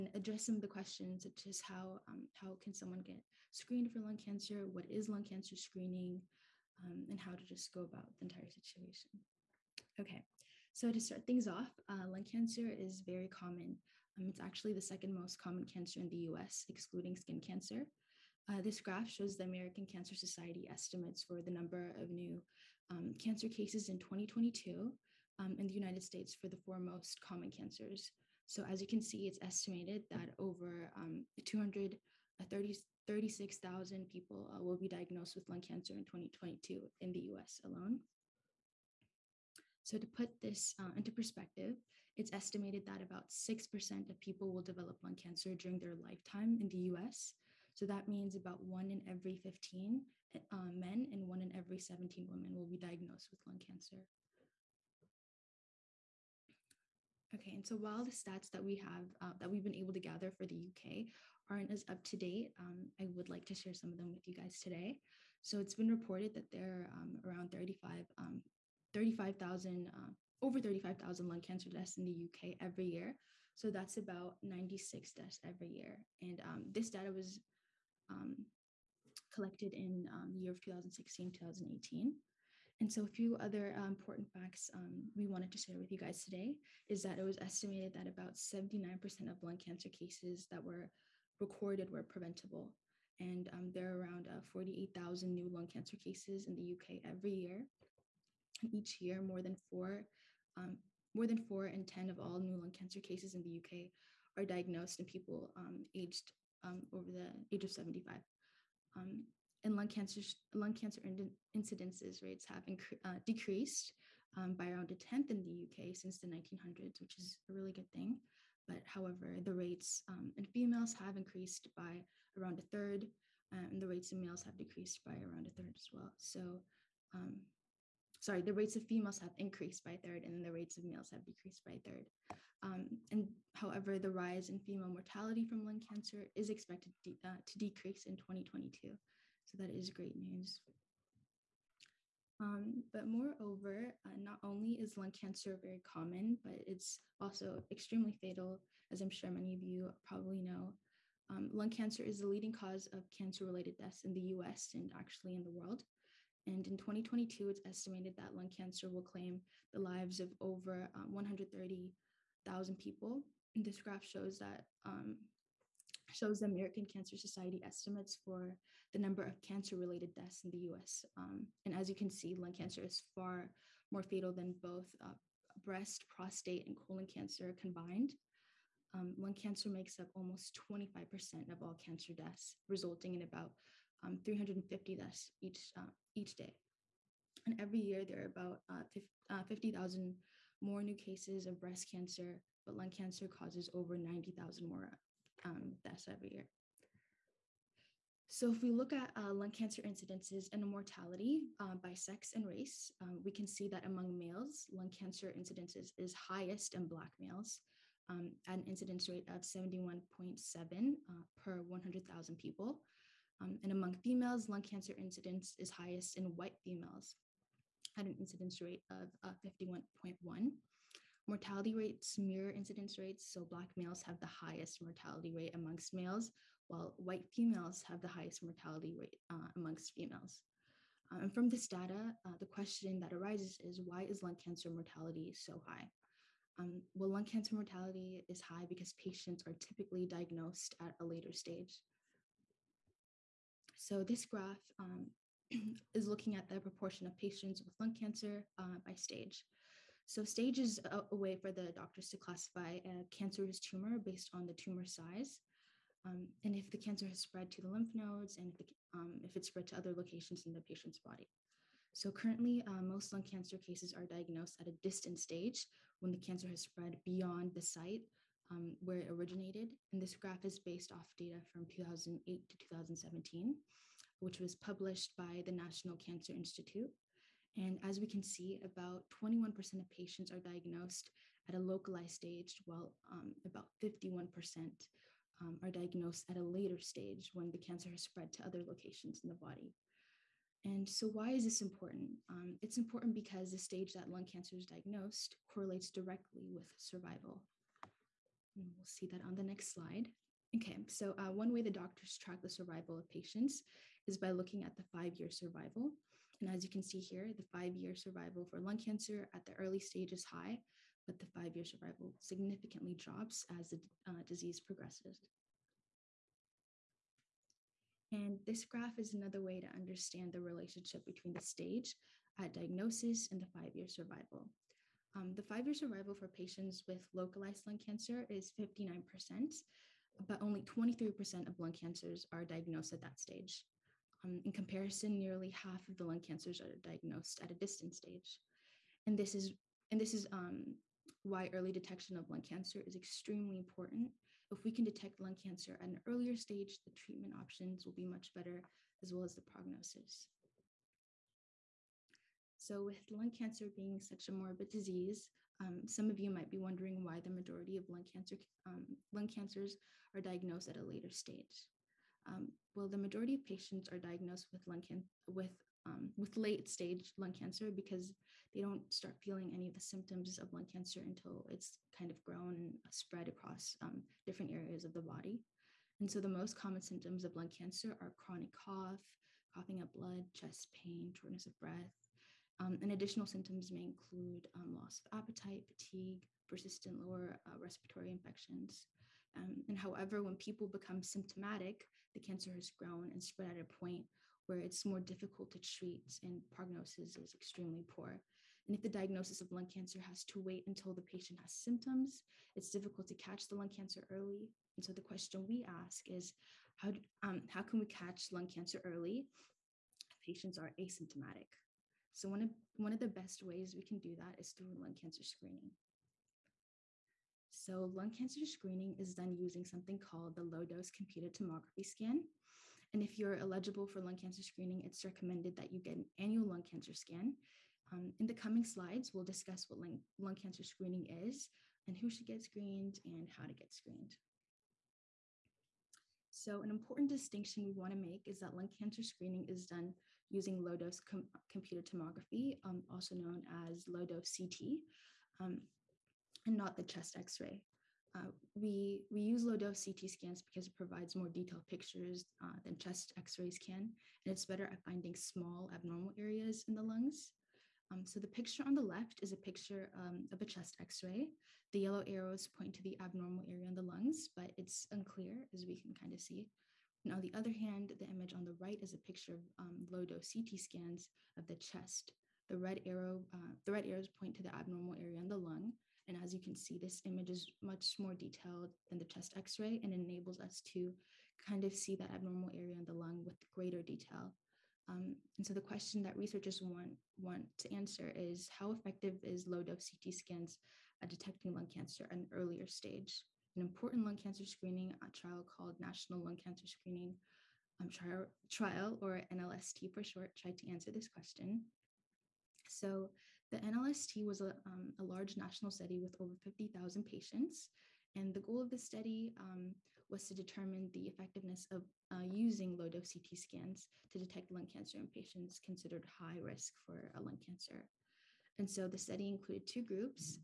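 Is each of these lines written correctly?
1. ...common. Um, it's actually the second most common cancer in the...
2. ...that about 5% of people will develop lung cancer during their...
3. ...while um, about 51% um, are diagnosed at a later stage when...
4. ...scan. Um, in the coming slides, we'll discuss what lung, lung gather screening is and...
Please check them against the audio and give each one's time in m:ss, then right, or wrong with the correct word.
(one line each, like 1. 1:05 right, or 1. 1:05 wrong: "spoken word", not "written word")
1. 0:13 right
2. 0:42 wrong: "6", not "5"
3. 4:42 right
4. 7:06 wrong: "cancer", not "gather".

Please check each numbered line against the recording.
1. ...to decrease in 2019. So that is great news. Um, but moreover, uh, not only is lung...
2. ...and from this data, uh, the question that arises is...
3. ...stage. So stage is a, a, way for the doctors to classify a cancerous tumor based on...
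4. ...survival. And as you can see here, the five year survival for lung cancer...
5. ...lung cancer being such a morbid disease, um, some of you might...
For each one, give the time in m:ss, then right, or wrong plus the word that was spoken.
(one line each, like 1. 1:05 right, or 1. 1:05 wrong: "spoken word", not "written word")
1. 2:17 wrong: "2022", not "2019"
2. 3:51 right
3. 4:08 right
4. 5:05 right
5. 5:53 right.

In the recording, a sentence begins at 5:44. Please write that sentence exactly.
If we can detect lung cancer at an earlier stage, the treatment options will be much better, as well as the prognosis.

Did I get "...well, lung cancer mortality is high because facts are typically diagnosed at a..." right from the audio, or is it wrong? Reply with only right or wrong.
wrong.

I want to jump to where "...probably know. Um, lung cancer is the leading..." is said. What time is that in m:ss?
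2:30.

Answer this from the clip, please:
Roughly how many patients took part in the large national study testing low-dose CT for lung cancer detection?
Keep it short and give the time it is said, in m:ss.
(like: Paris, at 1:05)
over 50,000, at 8:26.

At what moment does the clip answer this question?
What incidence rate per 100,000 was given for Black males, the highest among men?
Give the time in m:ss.
3:29.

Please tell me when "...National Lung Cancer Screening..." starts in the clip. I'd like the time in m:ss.
8:15.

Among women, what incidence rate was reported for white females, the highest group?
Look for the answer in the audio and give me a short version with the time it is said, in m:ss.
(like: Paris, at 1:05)
51.1, at 3:39.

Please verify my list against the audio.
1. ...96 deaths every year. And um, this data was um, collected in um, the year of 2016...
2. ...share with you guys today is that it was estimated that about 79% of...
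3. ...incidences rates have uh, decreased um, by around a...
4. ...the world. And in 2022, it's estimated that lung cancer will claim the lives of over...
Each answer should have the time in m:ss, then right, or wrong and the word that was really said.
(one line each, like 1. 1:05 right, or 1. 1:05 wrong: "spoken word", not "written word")
1. 1:14 right
2. 1:25 right
3. 1:51 right
4. 2:35 right.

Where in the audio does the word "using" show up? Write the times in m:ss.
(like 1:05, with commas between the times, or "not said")
6:59, 7:20, 8:32.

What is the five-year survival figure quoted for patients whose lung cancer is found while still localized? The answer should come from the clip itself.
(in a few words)
59%.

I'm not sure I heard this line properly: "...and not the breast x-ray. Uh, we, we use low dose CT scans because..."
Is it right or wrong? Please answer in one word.
wrong.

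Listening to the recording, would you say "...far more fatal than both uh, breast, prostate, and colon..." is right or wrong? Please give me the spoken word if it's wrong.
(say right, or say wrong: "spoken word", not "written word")
right.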